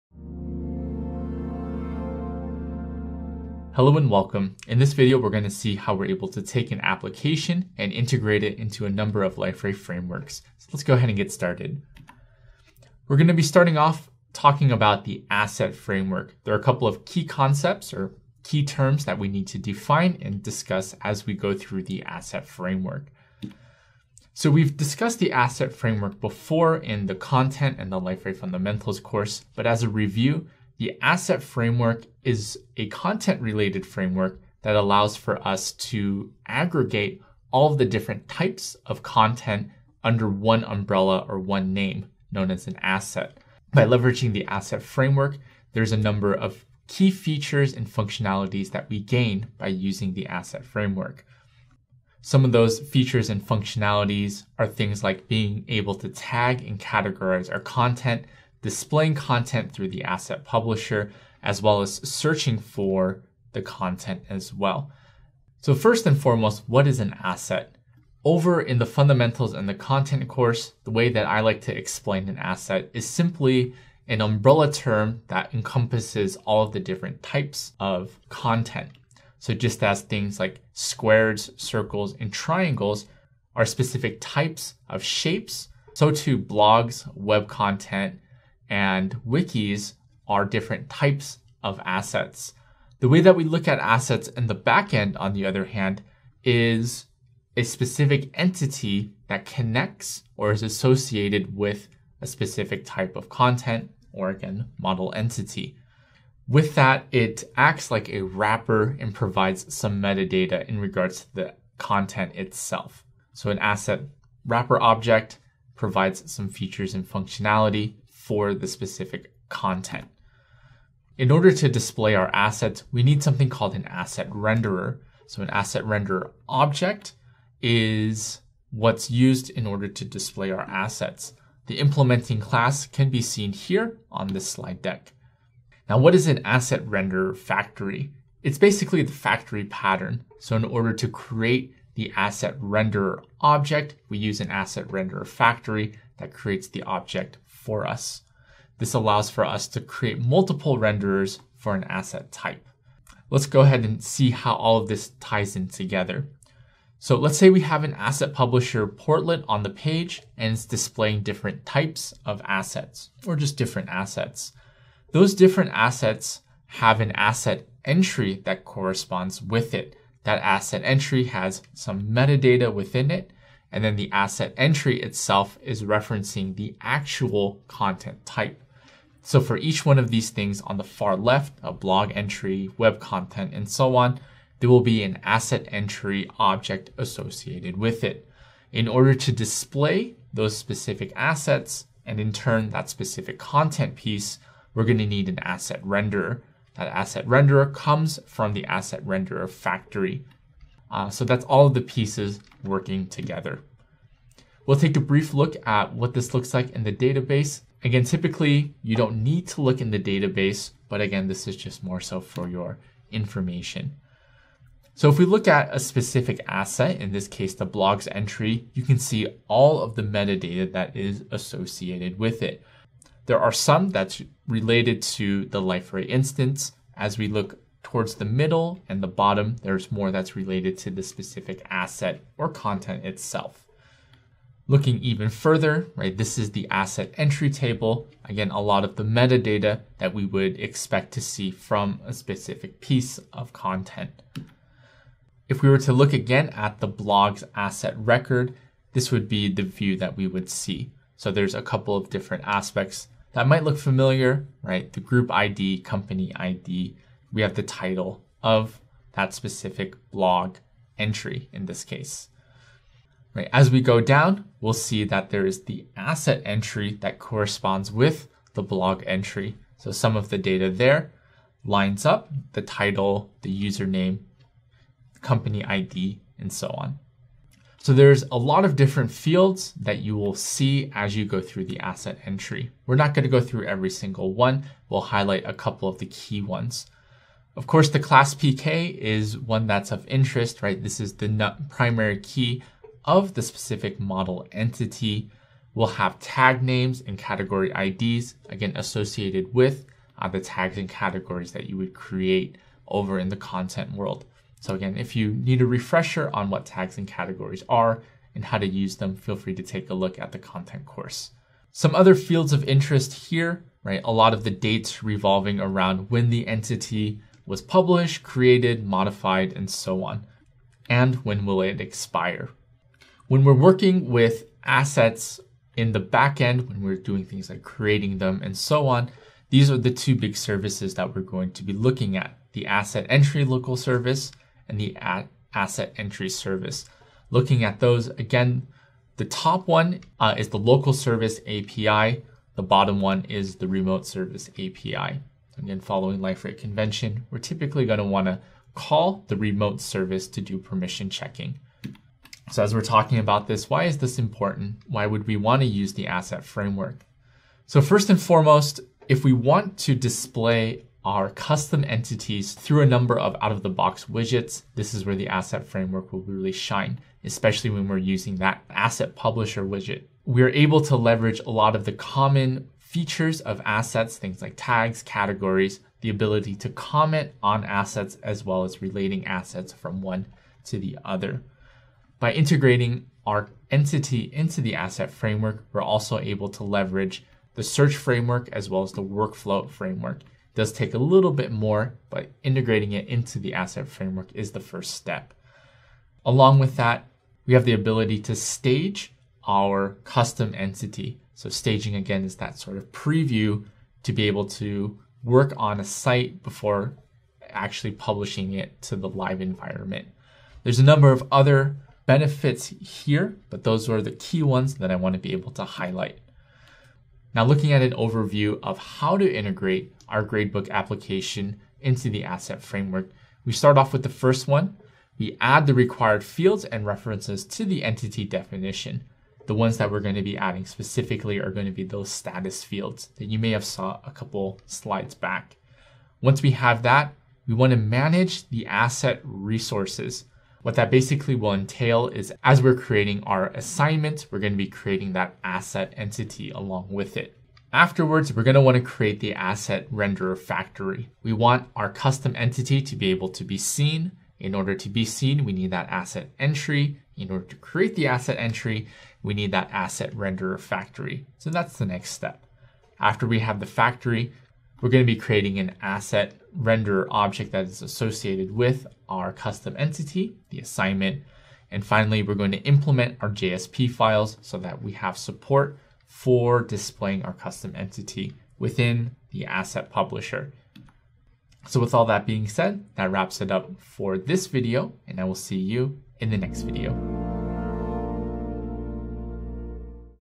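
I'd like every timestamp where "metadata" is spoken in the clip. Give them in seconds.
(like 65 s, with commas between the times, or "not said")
110 s, 172 s, 220 s, 239 s.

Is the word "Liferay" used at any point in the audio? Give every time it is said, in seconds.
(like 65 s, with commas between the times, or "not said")
9 s, 28 s, 225 s, 346 s.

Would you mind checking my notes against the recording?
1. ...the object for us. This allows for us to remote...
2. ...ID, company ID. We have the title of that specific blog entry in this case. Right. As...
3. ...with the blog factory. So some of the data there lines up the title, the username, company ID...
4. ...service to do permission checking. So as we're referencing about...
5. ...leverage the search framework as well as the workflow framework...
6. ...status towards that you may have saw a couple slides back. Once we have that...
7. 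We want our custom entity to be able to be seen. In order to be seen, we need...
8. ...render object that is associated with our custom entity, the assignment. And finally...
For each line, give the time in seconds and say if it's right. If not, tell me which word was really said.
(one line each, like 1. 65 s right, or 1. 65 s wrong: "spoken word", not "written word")
1. 146 s wrong: "create", not "remote"
2. 255 s right
3. 267 s wrong: "entry", not "factory"
4. 349 s wrong: "talking", not "referencing"
5. 386 s right
6. 432 s wrong: "fields", not "towards"
7. 451 s right
8. 466 s right.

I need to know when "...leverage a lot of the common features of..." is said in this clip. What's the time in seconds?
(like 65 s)
370 s.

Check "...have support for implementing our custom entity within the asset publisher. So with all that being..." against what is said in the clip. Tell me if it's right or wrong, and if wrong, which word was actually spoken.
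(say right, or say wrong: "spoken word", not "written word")
wrong: "displaying", not "implementing".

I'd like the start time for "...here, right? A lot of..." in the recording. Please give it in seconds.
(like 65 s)
313 s.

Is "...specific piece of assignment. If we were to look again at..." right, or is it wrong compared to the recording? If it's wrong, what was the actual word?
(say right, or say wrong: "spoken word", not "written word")
wrong: "content", not "assignment".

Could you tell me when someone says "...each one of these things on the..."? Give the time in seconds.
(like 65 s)
179 s.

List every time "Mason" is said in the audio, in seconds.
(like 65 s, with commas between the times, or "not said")
not said.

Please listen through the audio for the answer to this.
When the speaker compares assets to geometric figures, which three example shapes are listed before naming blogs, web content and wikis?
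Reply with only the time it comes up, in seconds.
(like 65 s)
80 s.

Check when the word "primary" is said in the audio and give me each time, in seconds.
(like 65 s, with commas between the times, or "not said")
291 s.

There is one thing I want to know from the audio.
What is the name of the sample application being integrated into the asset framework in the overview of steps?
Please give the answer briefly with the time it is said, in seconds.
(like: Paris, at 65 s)
gradebook, at 420 s.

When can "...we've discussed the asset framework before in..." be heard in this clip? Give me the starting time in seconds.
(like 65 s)
24 s.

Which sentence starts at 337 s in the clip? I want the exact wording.
Looking at those again, the top one uh, is the local service API.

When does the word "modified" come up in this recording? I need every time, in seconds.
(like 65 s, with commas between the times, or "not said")
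318 s.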